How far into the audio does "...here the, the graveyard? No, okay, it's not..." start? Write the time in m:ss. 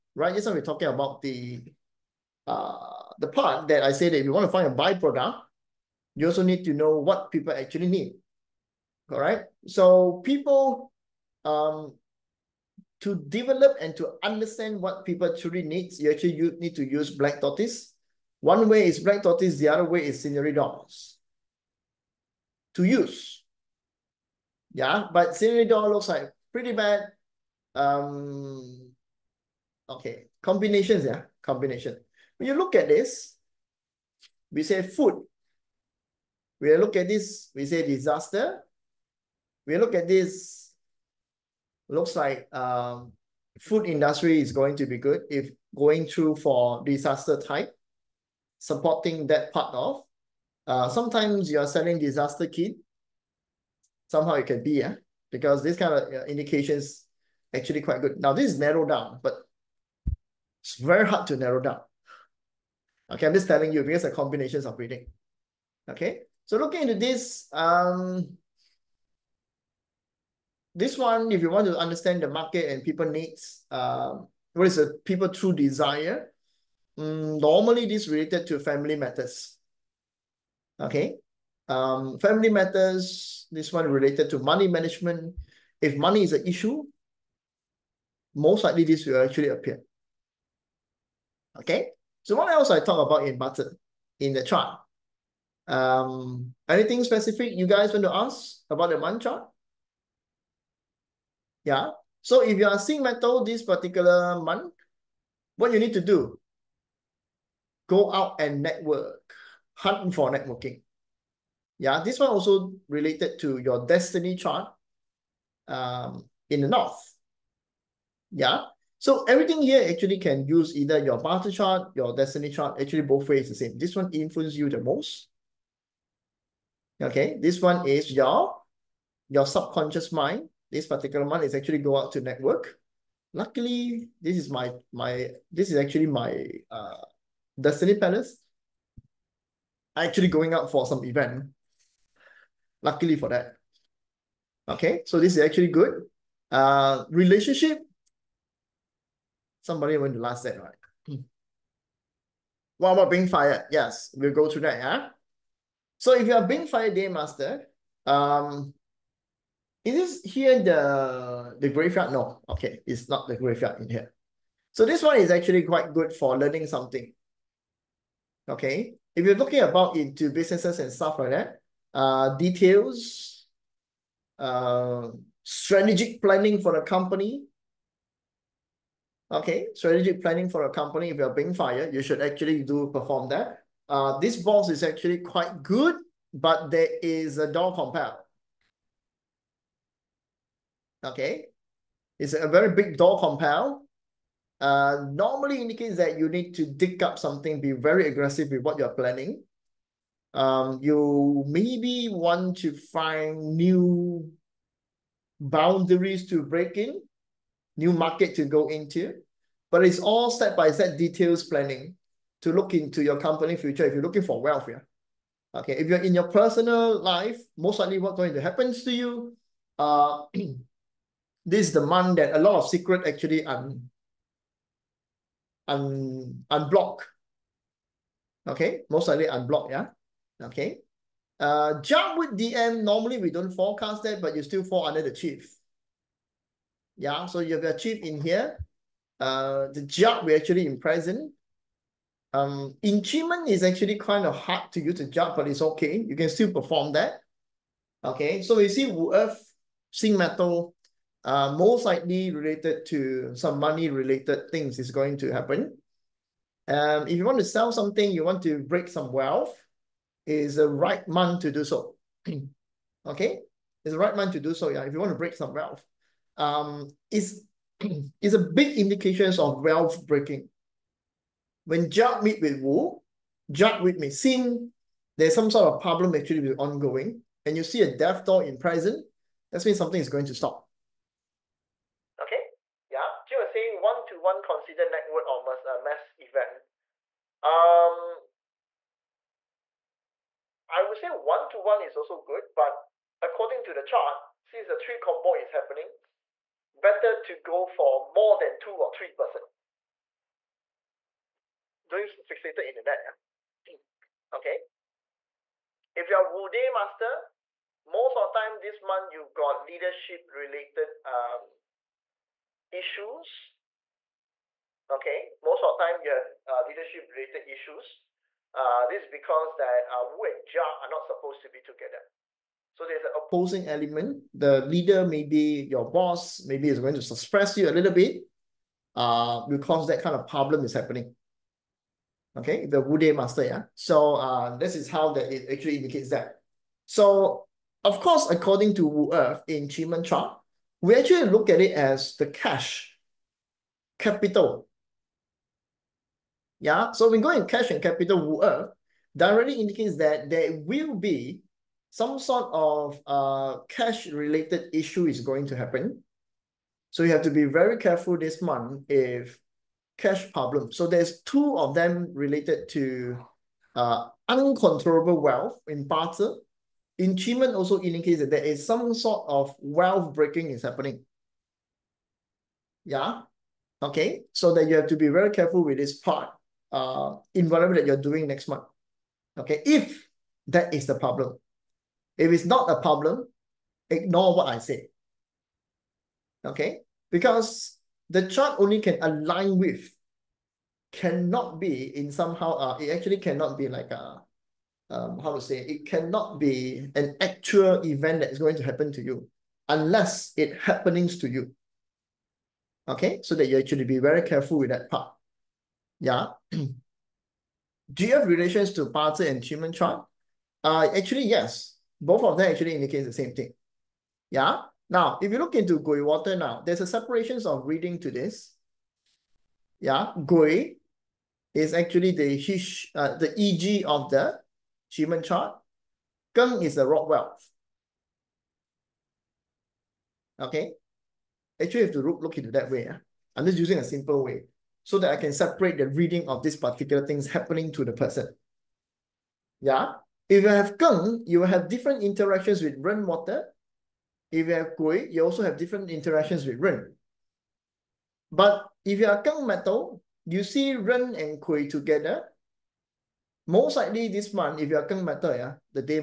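2:40.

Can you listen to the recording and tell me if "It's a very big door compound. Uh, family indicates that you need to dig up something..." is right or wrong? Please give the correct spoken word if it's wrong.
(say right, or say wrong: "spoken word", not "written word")
wrong: "normally", not "family".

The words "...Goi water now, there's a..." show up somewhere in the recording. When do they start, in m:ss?
6:55.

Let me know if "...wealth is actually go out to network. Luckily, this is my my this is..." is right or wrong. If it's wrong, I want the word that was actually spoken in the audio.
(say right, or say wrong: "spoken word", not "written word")
wrong: "month", not "wealth".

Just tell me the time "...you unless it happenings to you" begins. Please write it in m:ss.
6:39.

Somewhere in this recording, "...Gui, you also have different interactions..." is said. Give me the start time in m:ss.
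7:24.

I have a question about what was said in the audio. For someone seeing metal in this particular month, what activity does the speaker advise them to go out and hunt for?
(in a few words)
Networking.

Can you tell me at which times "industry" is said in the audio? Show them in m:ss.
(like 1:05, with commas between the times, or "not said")
0:43.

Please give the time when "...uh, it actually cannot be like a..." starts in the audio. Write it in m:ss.
6:32.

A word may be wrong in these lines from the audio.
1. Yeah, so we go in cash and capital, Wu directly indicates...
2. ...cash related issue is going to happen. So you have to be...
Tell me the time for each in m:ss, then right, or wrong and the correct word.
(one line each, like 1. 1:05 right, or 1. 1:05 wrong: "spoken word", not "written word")
1. 5:46 right
2. 5:53 right.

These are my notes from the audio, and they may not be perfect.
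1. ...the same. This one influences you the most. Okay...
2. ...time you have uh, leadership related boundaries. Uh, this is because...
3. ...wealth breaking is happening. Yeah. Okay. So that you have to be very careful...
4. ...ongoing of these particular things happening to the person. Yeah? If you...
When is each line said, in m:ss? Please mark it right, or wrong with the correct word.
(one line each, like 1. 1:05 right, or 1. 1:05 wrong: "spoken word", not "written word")
1. 2:03 right
2. 5:15 wrong: "issues", not "boundaries"
3. 6:09 right
4. 7:15 wrong: "reading", not "ongoing".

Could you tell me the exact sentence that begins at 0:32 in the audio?
When you look at this, we say food.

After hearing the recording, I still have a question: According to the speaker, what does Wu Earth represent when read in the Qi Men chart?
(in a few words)
Cash capital.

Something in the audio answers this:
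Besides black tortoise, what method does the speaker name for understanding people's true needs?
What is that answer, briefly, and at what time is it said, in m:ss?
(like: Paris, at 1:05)
Scenery doors, at 0:20.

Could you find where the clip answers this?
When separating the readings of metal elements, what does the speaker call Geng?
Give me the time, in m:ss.
7:06.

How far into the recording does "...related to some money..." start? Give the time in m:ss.
4:12.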